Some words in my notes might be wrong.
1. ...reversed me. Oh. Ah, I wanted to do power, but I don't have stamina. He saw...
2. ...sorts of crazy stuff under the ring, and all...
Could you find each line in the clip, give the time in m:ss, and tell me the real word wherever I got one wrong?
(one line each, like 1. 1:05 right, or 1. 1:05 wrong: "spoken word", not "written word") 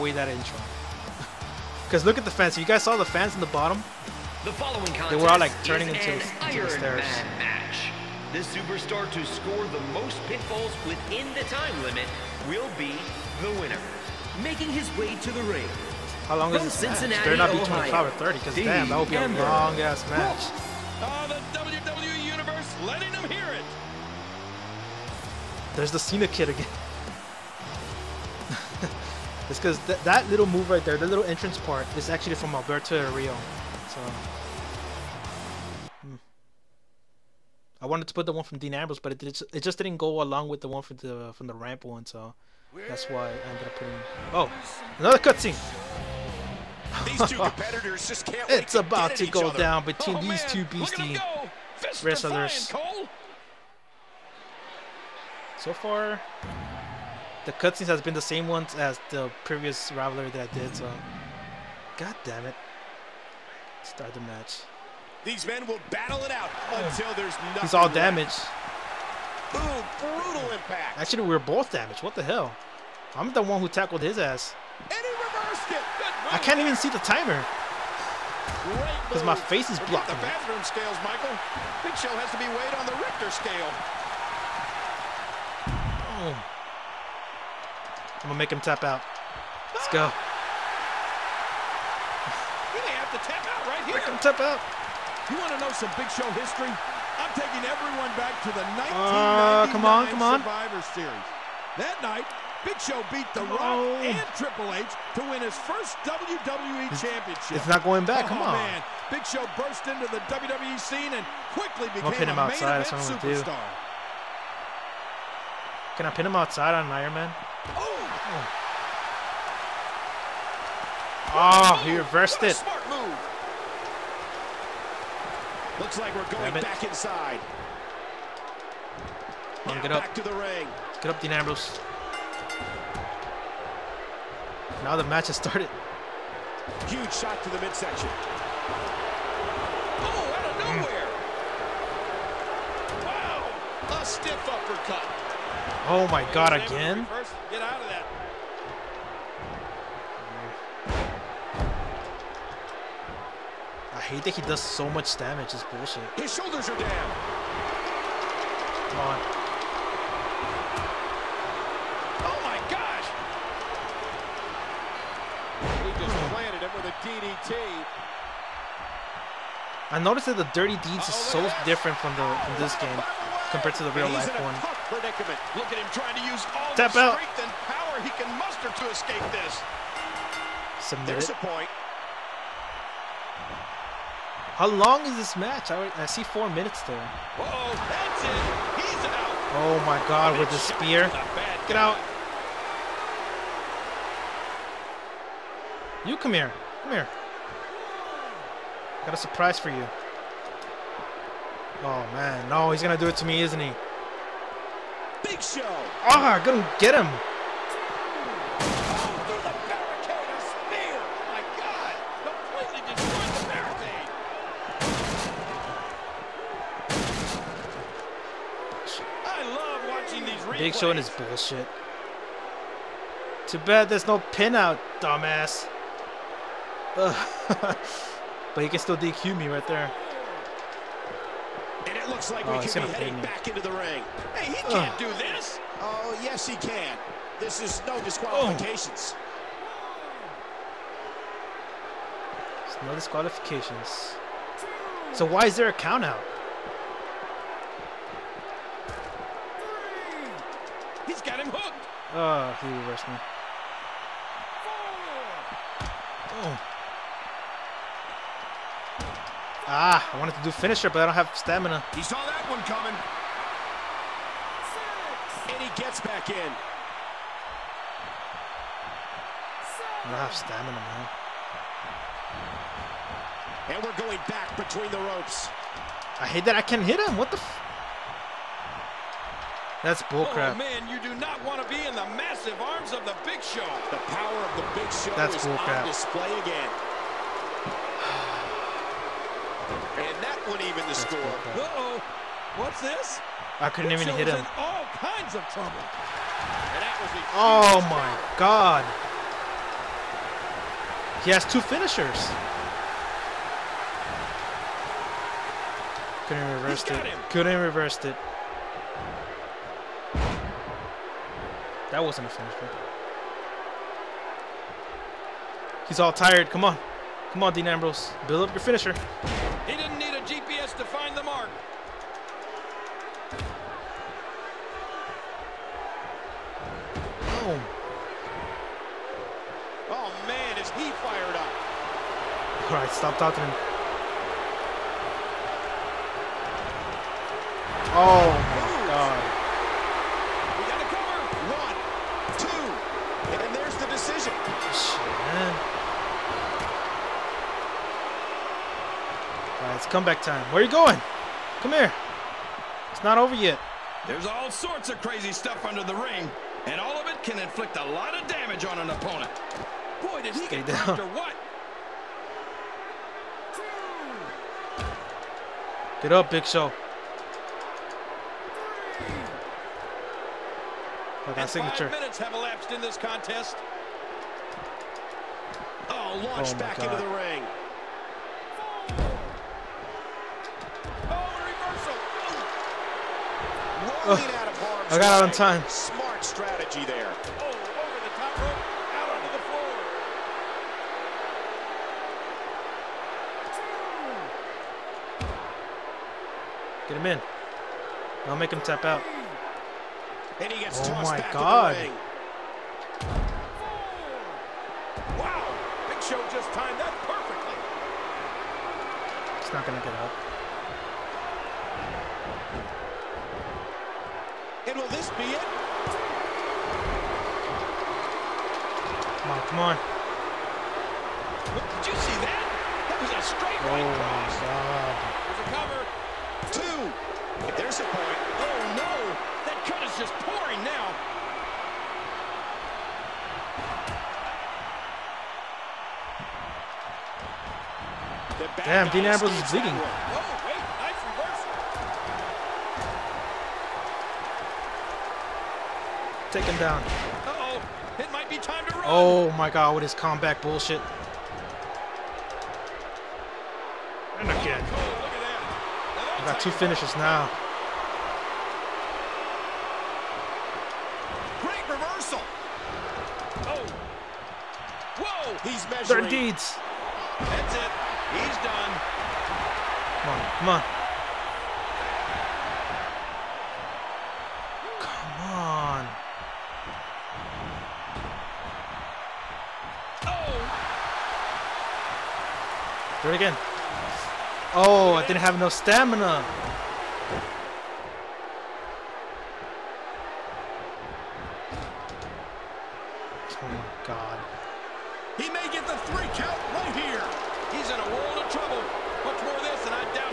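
1. 4:12 wrong: "finisher", not "power"
2. 5:54 right.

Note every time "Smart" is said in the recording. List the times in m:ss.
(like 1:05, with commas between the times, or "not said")
2:02, 6:25.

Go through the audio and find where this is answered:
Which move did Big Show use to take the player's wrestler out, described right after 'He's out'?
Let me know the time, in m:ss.
3:10.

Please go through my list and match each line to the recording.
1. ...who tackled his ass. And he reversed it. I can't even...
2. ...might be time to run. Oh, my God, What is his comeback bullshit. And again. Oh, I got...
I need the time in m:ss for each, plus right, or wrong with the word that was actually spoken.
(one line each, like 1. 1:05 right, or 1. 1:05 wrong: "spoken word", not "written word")
1. 1:13 right
2. 7:28 right.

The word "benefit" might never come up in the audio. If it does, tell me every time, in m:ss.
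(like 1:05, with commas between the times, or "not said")
not said.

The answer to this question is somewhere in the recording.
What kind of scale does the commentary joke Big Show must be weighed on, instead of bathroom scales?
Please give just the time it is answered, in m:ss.
1:23.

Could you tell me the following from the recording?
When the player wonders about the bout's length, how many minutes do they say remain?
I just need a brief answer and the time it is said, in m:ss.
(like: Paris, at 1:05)
4, at 3:06.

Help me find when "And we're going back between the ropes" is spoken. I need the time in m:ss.
4:33.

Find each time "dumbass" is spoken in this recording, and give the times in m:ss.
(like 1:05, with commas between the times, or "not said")
3:44.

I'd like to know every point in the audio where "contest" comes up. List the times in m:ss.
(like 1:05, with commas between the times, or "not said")
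0:04, 6:12.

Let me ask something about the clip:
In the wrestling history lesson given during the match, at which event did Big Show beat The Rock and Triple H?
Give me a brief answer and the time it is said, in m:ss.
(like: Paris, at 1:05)
1999 Survivor Series, at 1:38.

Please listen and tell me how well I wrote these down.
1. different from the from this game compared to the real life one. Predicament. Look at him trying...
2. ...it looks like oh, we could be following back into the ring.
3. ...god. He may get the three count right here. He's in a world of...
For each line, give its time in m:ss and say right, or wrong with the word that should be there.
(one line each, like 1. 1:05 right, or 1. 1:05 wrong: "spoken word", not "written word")
1. 2:51 right
2. 3:51 wrong: "heading", not "following"
3. 8:13 right.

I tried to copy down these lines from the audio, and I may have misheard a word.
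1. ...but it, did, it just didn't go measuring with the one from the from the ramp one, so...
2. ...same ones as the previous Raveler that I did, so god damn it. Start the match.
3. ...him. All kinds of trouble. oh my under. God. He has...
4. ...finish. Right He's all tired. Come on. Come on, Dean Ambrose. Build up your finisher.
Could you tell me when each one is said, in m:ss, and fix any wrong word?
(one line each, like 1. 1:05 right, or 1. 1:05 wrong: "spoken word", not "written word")
1. 0:38 wrong: "along", not "measuring"
2. 0:58 right
3. 4:54 wrong: "power", not "under"
4. 5:12 right.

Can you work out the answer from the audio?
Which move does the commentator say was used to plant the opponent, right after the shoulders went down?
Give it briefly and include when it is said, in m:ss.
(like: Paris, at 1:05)
DDT, at 2:47.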